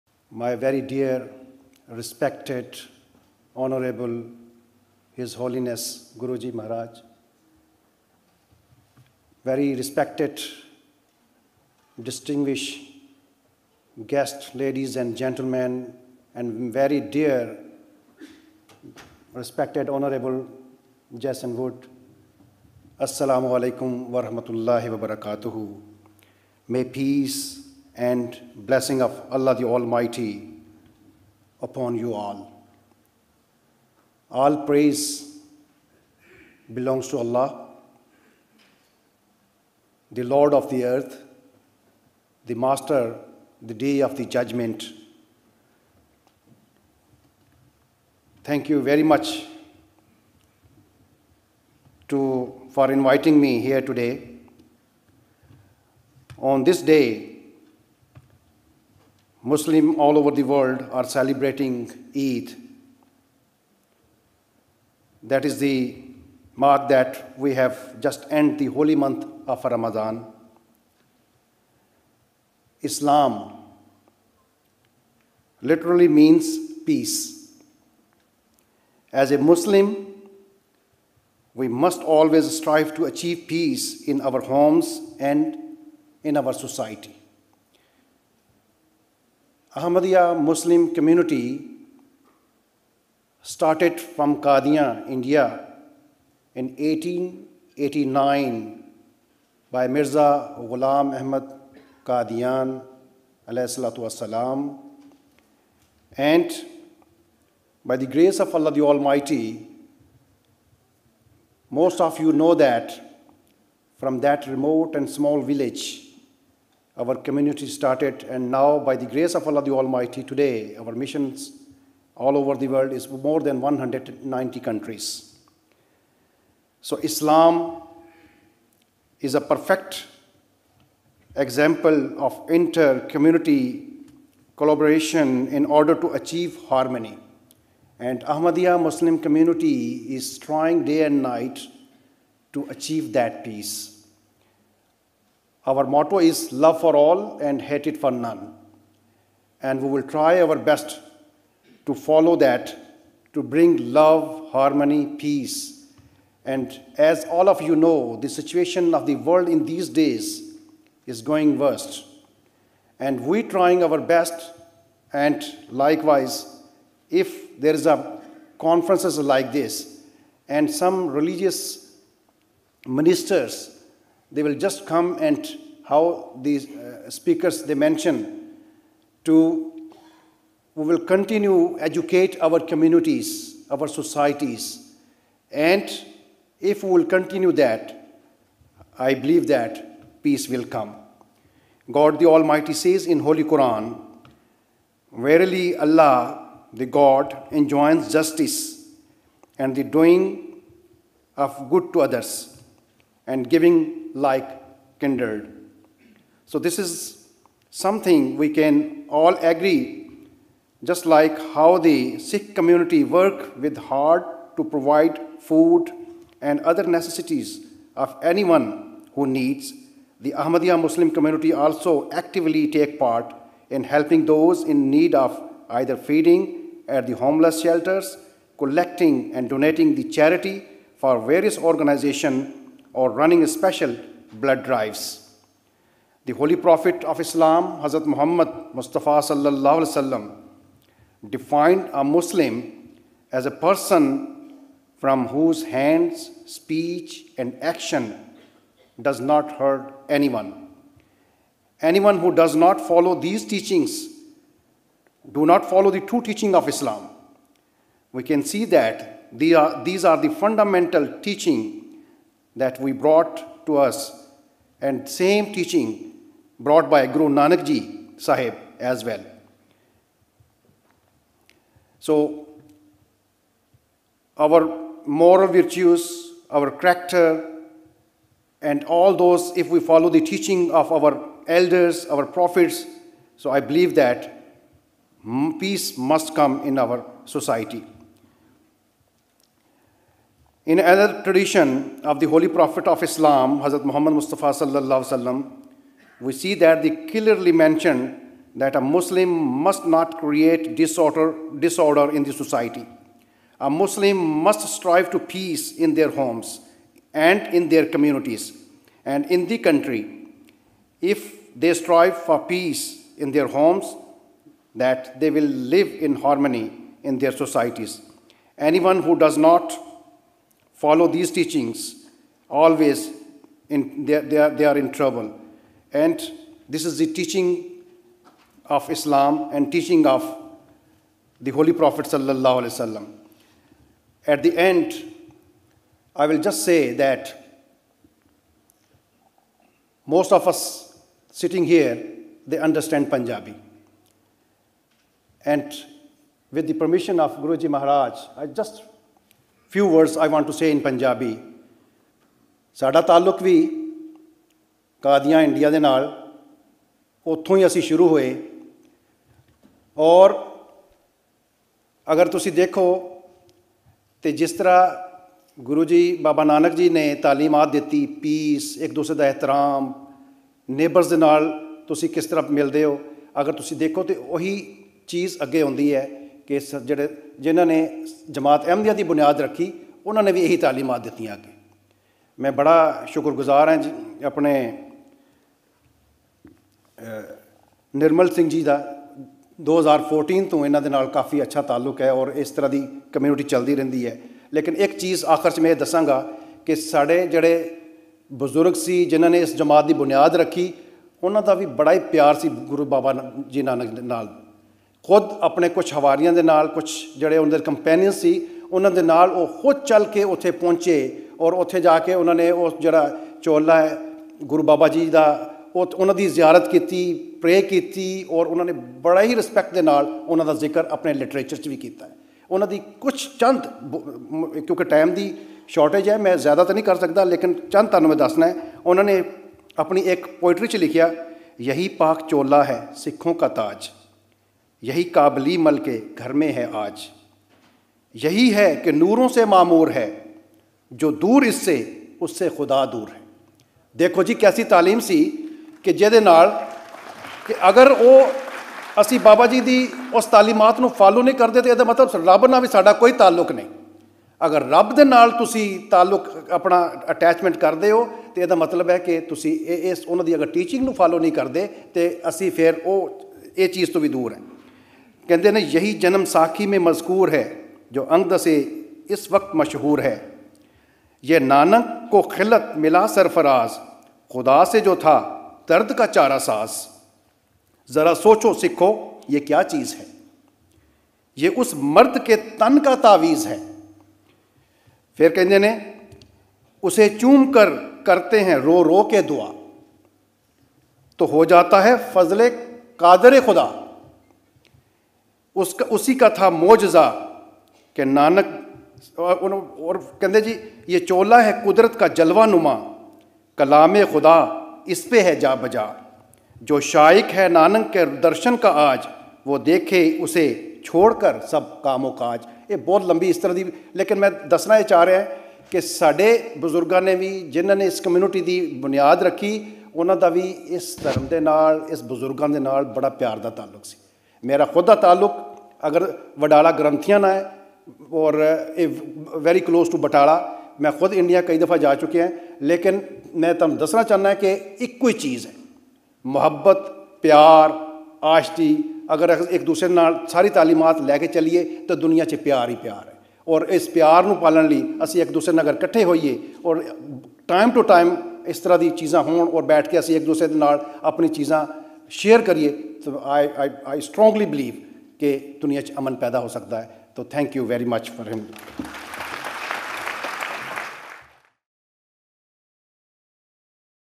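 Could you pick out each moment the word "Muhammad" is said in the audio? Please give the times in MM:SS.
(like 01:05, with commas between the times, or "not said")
03:58, 04:53.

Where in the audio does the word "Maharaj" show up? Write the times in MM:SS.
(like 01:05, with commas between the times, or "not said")
00:06, 05:47.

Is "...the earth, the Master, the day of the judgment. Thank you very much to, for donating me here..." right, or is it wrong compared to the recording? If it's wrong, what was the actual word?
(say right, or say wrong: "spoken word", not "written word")
wrong: "inviting", not "donating".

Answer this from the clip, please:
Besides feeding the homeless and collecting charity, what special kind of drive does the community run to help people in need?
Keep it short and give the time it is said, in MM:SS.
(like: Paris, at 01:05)
Blood drives, at 03:54.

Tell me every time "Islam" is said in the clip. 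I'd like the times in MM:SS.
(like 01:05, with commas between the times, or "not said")
01:12, 02:06, 03:57, 04:16, 04:53, 05:28.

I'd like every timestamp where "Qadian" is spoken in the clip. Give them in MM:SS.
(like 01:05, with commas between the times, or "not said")
01:34, 01:42.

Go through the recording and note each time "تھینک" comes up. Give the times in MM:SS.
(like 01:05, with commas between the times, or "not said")
09:17.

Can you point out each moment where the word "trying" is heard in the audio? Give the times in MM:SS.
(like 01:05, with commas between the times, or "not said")
02:20, 02:43.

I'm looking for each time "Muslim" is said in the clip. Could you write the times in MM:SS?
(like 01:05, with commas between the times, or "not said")
00:59, 01:19, 01:30, 02:18, 03:40, 04:02, 04:58, 05:03.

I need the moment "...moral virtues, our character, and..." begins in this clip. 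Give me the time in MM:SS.
04:35.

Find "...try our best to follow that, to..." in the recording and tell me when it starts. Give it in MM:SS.
02:30.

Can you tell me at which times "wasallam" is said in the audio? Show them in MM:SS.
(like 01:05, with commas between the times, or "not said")
03:59, 04:55, 05:32.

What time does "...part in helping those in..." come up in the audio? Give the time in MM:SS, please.
03:42.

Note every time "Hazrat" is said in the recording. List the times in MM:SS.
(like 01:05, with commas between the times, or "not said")
03:57, 04:53.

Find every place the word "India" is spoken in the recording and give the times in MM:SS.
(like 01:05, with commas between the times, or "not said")
01:35.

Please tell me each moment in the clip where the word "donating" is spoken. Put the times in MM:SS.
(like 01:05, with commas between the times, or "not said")
03:49.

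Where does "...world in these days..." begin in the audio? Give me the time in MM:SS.
02:39.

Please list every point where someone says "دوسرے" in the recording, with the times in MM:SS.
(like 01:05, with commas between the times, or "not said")
08:59, 09:05, 09:10.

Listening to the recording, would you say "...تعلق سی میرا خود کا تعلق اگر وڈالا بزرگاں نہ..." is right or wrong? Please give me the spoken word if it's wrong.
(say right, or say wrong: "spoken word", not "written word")
wrong: "گرنتیاں", not "بزرگاں".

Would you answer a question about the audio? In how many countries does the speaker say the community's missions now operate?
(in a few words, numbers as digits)
More than 190.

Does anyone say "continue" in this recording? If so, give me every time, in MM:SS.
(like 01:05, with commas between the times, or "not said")
03:00, 03:07.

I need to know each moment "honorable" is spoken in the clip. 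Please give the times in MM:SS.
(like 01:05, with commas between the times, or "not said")
00:03, 00:19.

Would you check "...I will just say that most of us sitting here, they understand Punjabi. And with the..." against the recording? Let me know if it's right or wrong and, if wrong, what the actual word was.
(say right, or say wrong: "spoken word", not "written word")
right.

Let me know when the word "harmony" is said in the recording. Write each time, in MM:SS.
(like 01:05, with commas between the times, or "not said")
02:16, 02:34, 05:16.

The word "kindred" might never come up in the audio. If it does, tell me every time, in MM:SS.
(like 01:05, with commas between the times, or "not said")
03:24.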